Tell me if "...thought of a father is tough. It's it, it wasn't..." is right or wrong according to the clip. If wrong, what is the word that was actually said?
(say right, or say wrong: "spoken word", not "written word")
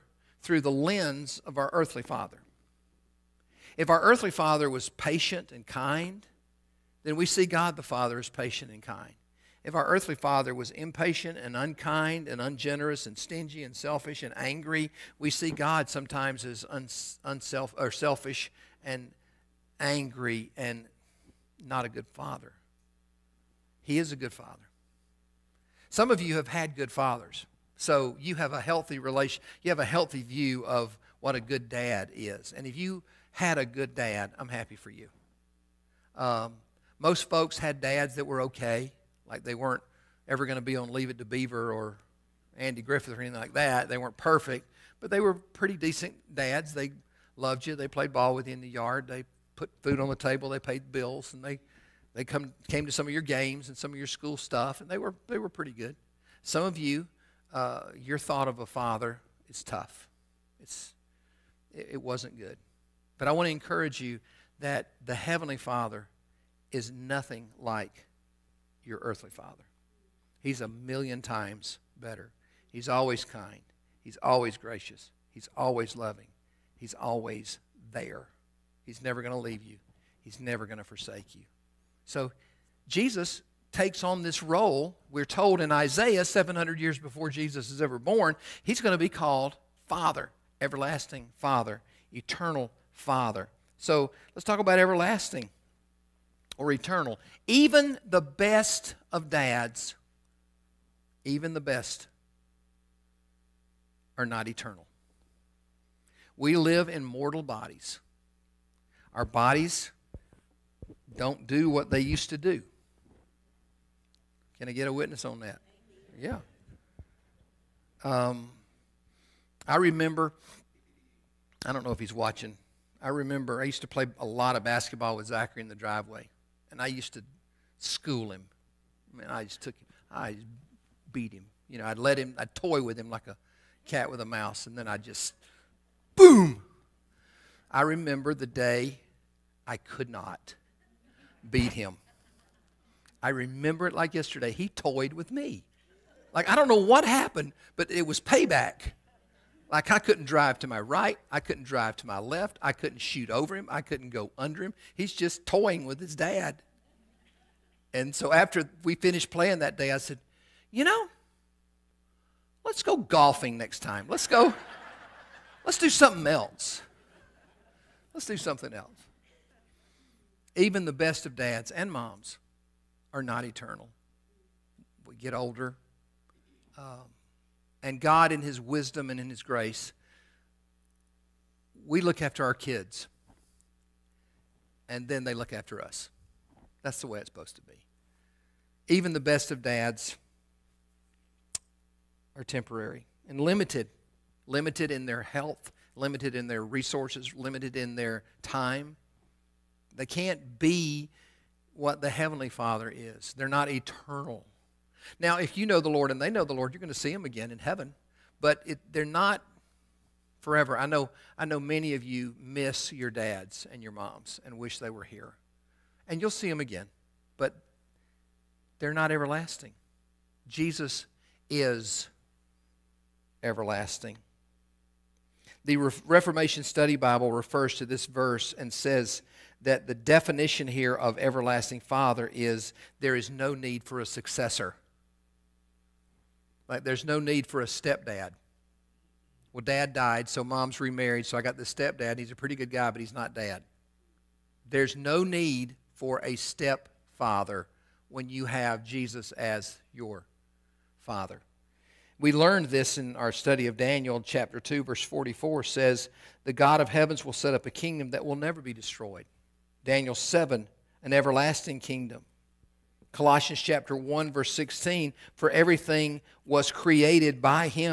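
right.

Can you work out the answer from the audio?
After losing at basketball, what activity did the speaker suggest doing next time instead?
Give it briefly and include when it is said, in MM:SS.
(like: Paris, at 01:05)
Golfing, at 02:42.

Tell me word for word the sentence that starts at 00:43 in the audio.
They weren't perfect, but they were pretty decent dads.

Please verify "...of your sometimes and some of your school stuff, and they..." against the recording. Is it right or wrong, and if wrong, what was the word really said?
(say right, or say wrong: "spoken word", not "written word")
wrong: "games", not "sometimes".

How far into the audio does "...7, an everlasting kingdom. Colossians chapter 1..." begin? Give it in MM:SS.
04:20.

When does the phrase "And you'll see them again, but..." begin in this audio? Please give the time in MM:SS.
03:36.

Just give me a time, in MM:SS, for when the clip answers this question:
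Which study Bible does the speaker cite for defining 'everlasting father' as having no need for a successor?
03:46.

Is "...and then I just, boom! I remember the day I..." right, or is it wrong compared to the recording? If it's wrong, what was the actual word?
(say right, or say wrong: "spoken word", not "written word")
right.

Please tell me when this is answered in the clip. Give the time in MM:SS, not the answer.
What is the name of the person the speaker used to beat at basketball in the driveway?
02:05.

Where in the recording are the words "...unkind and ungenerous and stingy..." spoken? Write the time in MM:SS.
00:11.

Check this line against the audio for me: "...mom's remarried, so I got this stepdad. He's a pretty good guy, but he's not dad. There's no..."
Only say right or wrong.
right.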